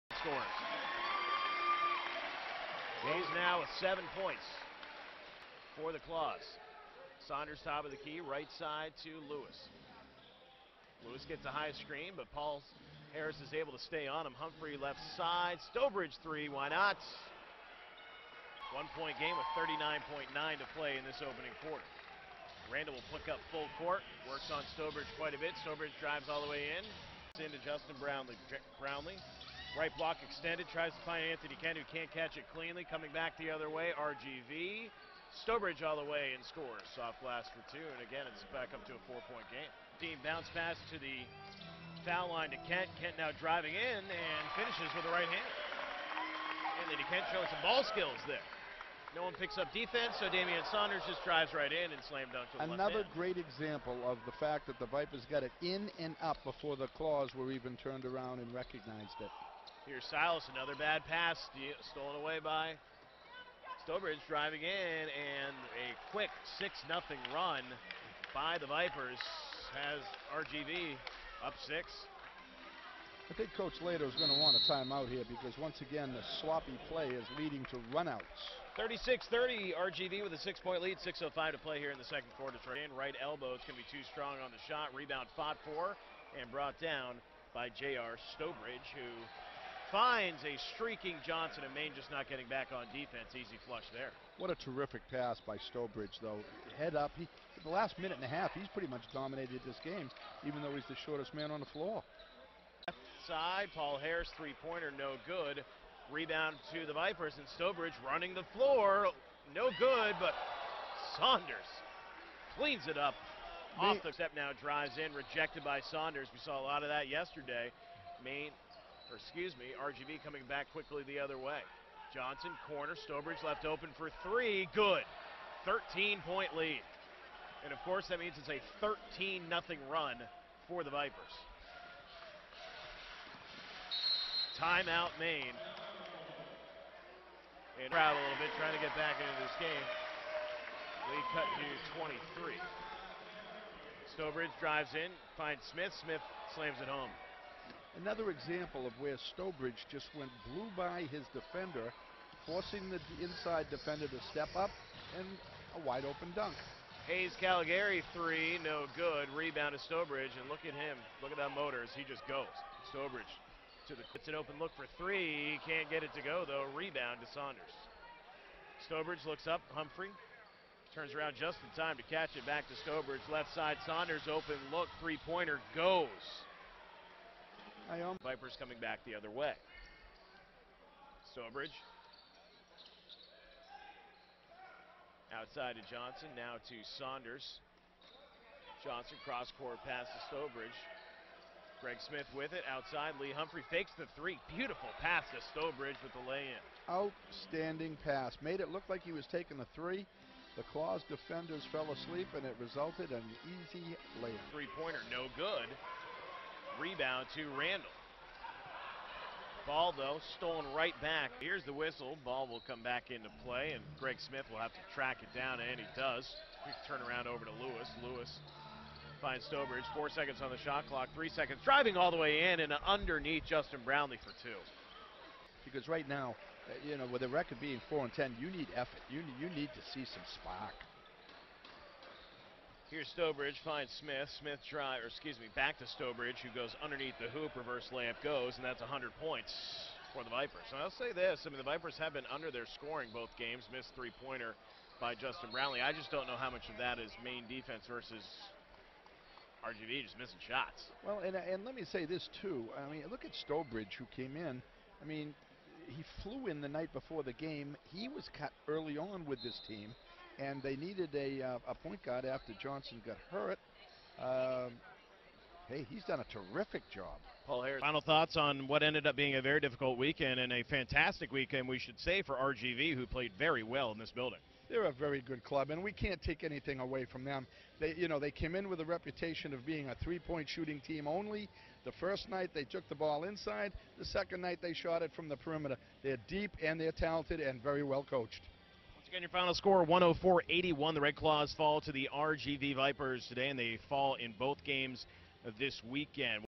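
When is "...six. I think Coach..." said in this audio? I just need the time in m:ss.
1:11.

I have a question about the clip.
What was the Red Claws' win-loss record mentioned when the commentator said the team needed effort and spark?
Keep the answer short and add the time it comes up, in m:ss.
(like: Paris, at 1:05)
4 and 10, at 3:47.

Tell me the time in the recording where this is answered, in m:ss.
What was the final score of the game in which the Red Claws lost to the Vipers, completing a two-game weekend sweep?
4:49.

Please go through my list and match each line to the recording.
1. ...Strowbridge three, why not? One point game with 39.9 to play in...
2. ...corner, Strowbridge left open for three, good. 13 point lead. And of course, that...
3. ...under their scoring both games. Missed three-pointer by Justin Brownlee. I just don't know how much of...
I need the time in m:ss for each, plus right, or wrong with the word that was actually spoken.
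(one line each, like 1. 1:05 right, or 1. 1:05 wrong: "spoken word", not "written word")
1. 0:15 right
2. 2:02 right
3. 4:02 right.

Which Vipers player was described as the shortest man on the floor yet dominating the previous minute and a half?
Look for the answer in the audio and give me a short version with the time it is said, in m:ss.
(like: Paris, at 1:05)
Jay-R Strowbridge, at 1:27.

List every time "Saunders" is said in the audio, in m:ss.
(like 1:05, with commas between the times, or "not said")
0:07, 0:50, 1:51, 1:55, 2:47, 2:53, 3:06.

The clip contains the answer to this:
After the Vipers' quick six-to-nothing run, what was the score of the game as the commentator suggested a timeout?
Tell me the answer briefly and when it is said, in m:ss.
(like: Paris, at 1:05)
36-30, at 1:18.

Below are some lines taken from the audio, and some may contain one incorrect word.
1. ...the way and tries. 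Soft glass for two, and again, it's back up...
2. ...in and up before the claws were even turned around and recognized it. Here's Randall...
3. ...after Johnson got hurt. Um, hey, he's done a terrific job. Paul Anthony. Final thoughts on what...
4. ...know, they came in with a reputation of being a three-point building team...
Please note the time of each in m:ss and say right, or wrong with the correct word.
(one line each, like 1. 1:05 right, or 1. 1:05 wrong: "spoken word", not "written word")
1. 0:35 wrong: "scores", not "tries"
2. 0:55 wrong: "Silas", not "Randall"
3. 4:22 wrong: "Harris", not "Anthony"
4. 4:38 wrong: "shooting", not "building".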